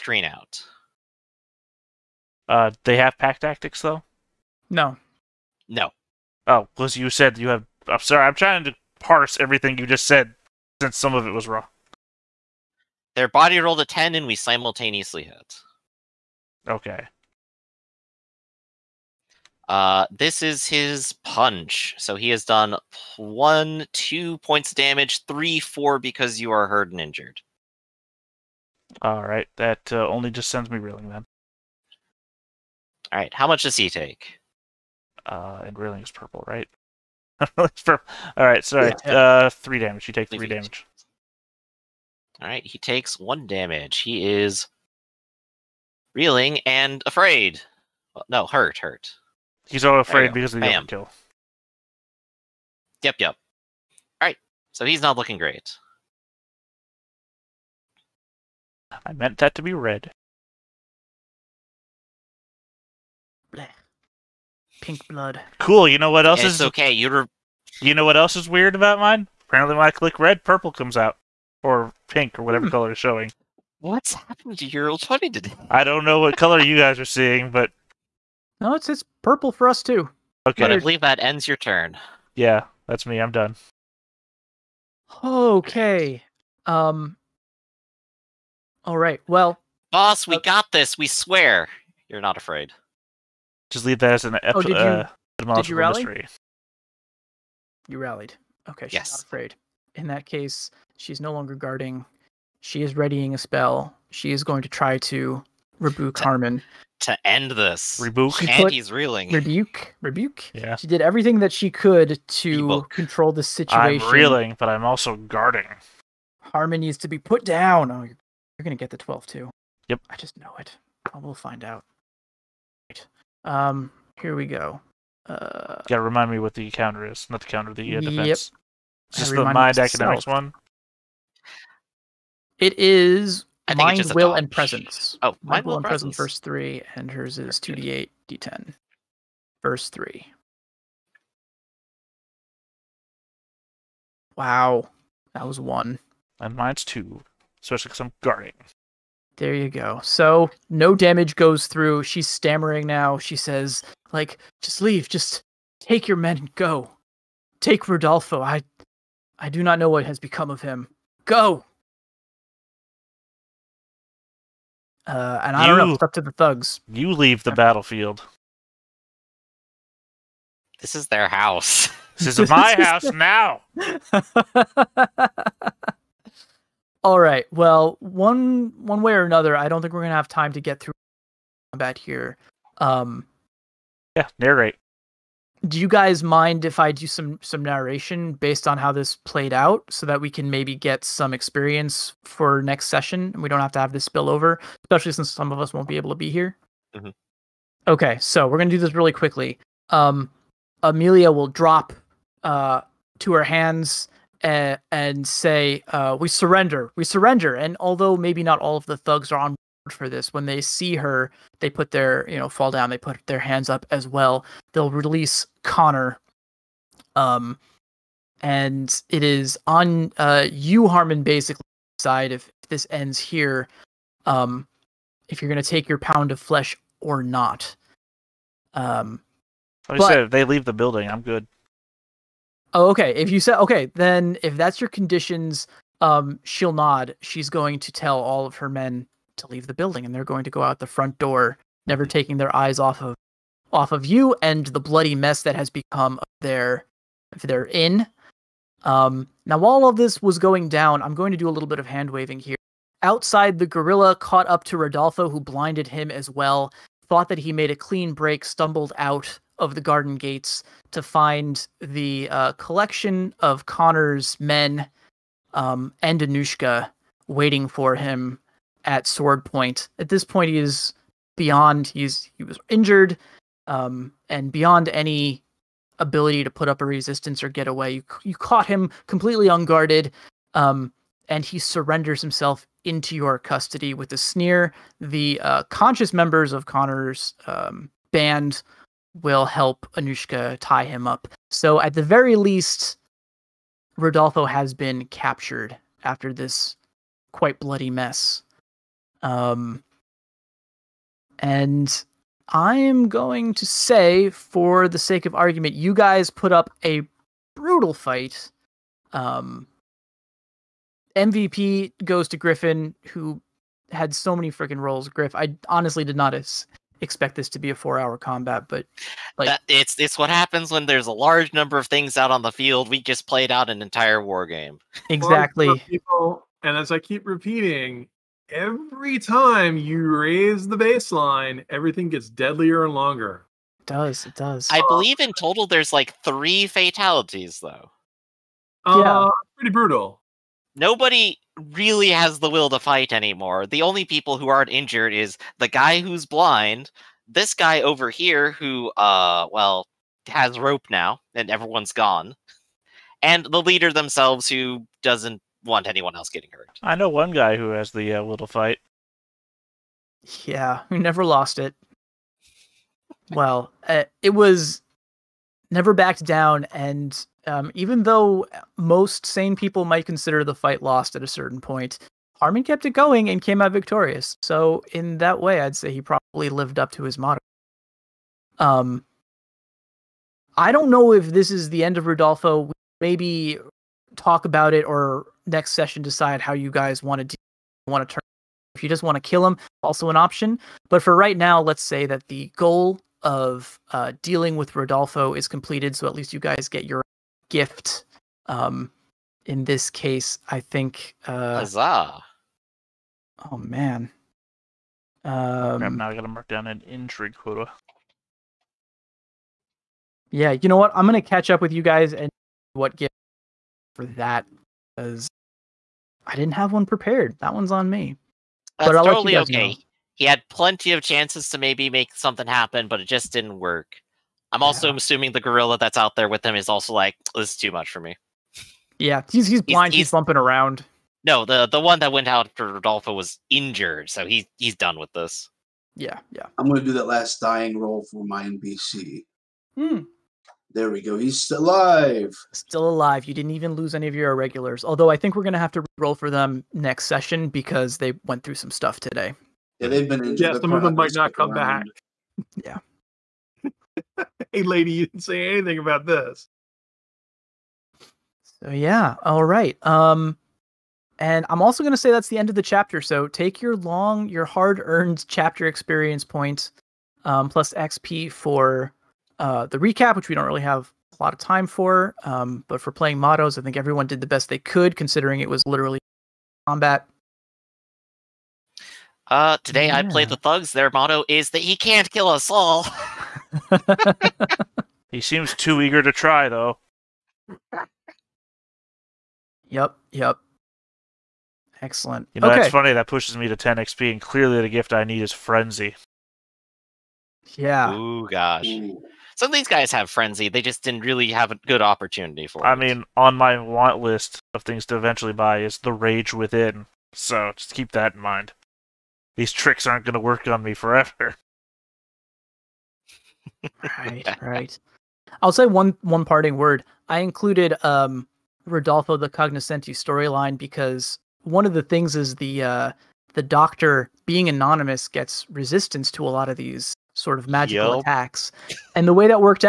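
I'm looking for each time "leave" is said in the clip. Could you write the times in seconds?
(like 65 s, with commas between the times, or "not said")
93 s, 154 s, 167 s, 230 s, 239 s.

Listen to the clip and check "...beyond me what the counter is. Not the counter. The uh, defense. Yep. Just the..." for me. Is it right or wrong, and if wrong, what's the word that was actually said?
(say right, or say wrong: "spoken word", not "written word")
wrong: "remind", not "beyond".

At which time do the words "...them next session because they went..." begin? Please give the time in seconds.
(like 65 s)
446 s.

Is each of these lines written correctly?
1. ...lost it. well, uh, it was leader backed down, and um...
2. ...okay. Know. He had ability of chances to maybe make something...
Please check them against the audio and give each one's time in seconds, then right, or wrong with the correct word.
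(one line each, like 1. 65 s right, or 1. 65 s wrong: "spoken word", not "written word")
1. 361 s wrong: "never", not "leader"
2. 419 s wrong: "plenty", not "ability".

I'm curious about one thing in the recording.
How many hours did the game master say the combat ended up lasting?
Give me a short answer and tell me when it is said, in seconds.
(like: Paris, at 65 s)
4, at 317 s.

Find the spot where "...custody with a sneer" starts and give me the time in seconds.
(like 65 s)
283 s.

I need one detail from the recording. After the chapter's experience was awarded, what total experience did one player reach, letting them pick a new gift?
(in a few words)
10 XP.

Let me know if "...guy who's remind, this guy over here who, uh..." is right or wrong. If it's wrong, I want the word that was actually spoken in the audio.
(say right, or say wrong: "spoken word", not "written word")
wrong: "blind", not "remind".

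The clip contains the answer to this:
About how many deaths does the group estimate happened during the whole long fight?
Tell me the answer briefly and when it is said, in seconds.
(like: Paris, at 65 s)
3, at 336 s.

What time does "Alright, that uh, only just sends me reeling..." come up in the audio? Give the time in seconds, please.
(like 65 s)
29 s.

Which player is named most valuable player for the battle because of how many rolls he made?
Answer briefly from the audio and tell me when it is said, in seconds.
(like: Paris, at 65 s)
Griffin, at 312 s.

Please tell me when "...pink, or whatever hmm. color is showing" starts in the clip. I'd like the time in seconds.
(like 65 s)
72 s.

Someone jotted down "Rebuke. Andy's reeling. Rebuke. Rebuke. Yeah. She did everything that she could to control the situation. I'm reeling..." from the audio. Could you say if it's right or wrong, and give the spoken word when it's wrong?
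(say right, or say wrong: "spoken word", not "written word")
right.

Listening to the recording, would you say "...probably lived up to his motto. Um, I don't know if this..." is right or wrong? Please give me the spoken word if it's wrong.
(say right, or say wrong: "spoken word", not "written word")
right.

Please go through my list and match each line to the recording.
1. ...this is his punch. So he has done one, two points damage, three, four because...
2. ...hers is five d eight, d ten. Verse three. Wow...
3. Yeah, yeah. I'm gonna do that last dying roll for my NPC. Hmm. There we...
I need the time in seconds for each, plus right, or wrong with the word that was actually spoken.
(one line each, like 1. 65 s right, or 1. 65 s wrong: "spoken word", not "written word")
1. 20 s right
2. 137 s wrong: "two", not "five"
3. 435 s right.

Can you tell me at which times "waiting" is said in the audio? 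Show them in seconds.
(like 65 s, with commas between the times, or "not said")
267 s.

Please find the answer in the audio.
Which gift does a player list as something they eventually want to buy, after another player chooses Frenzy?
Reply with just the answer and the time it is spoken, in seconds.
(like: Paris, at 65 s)
The Rage Within, at 505 s.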